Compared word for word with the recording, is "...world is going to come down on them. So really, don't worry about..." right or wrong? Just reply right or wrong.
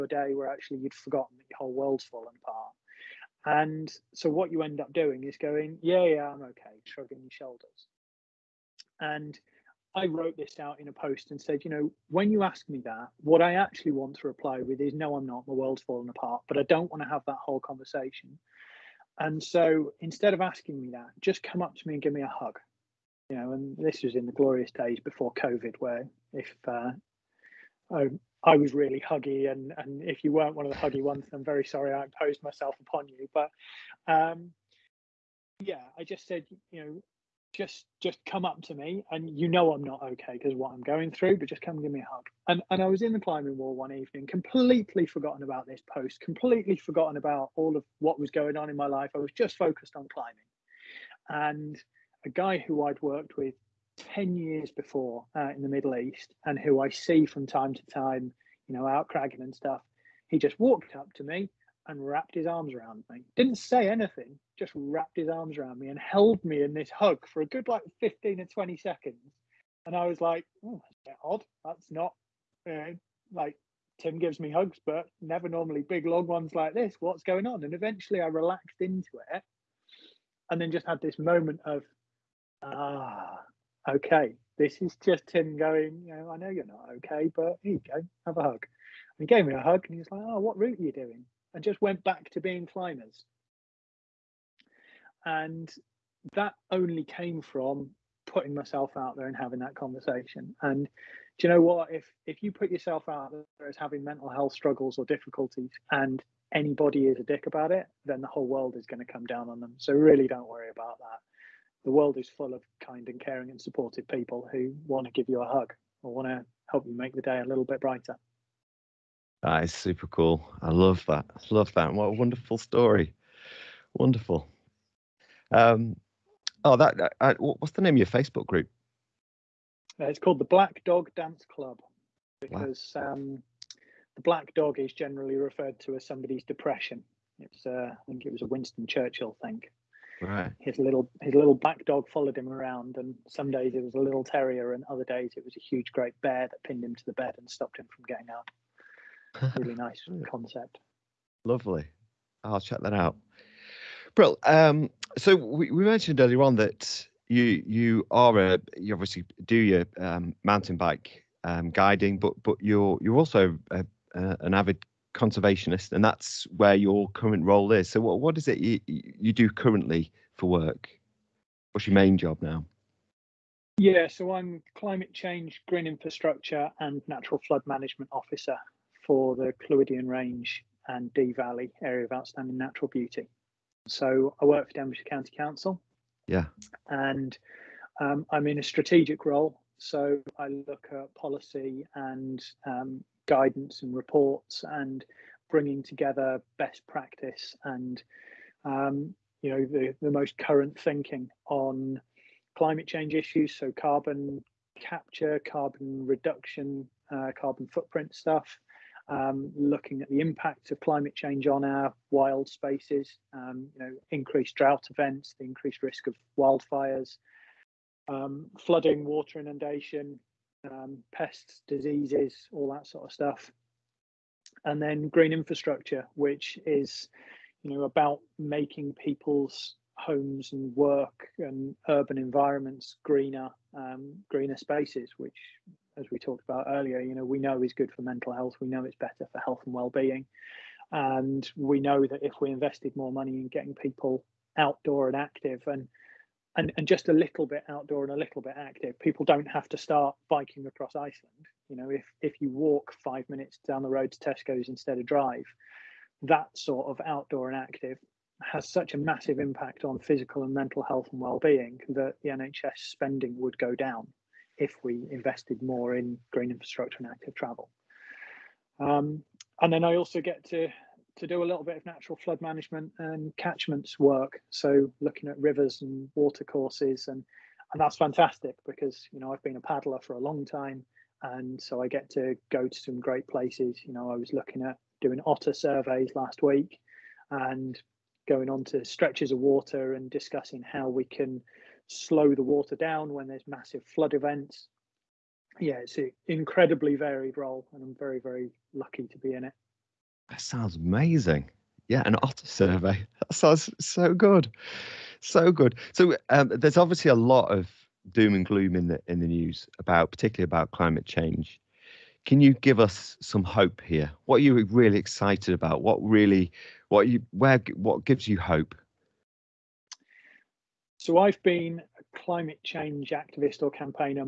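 right.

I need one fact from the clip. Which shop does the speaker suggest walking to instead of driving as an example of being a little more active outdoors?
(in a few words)
Tesco.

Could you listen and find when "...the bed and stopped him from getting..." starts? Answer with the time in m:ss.
2:27.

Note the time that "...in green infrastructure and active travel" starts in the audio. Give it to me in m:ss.
4:25.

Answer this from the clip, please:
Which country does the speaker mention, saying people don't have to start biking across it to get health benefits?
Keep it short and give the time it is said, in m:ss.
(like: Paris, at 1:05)
Iceland, at 4:10.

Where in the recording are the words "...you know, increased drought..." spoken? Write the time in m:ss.
3:33.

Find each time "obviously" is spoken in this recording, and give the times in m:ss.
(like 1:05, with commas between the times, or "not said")
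2:38, 5:06.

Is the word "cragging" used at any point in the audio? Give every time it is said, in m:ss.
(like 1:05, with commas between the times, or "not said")
0:59.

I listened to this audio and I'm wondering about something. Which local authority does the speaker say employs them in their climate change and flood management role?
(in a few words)
Denbighshire County Council.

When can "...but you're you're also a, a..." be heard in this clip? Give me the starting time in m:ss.
2:42.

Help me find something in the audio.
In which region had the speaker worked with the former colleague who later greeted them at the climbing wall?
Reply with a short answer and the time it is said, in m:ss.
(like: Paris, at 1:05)
Middle East, at 0:55.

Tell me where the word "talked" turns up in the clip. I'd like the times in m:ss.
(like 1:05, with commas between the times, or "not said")
3:56.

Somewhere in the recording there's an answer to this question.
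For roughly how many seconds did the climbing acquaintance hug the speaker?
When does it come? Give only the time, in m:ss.
1:07.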